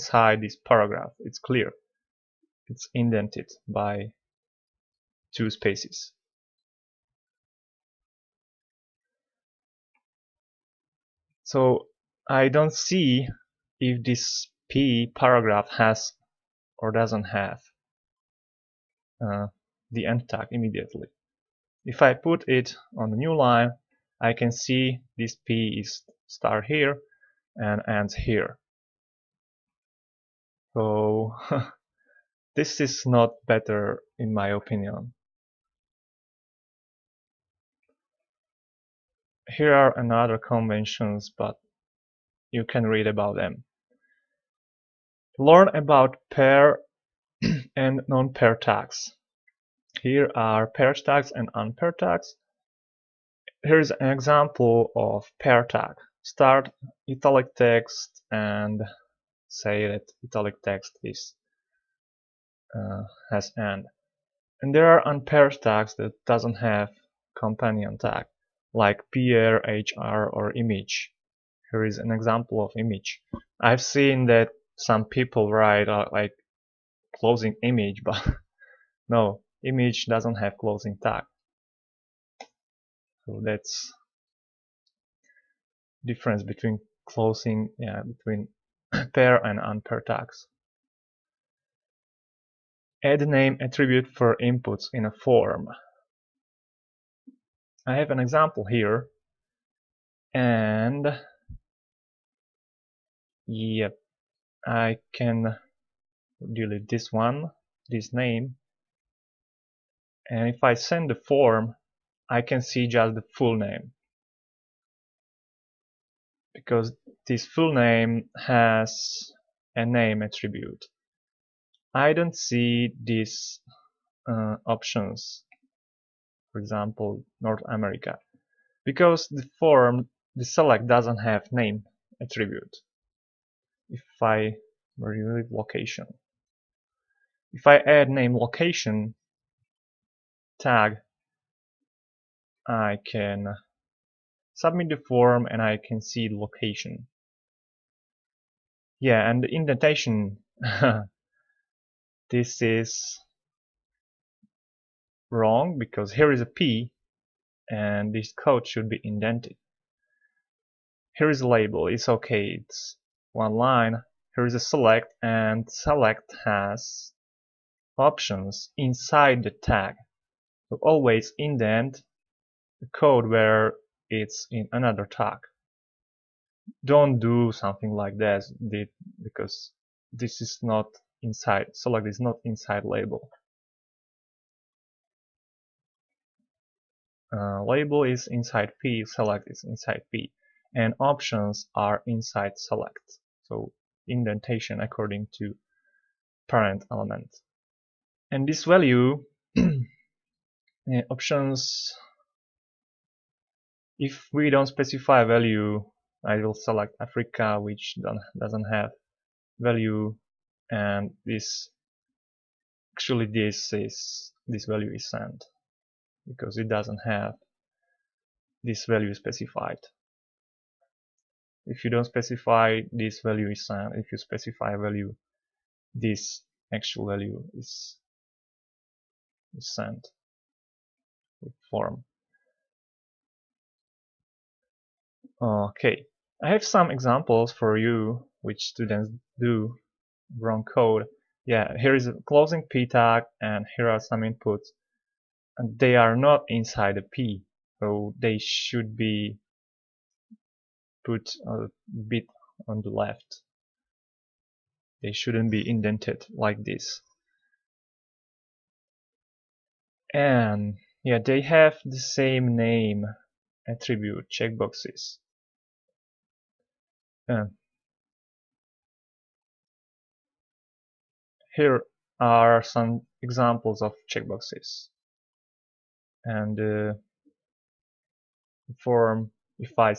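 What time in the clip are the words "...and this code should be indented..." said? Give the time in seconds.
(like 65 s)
157 s.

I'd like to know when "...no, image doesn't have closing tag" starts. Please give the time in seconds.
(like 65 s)
79 s.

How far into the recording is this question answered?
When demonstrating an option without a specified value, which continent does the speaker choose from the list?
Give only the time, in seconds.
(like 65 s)
207 s.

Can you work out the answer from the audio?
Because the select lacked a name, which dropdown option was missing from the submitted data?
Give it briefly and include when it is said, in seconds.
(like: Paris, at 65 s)
North America, at 127 s.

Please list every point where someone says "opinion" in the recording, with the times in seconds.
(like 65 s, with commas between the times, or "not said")
34 s.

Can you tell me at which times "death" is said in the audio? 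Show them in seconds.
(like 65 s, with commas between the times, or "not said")
not said.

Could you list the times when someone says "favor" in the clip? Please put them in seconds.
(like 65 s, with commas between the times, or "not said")
not said.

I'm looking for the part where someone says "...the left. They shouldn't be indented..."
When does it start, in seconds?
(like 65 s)
252 s.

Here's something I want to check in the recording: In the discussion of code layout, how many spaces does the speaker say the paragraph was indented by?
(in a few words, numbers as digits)
2.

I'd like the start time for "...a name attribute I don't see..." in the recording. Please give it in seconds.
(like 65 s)
119 s.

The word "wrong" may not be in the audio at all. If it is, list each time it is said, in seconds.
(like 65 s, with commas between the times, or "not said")
155 s, 240 s.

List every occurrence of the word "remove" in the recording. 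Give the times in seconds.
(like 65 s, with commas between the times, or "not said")
134 s.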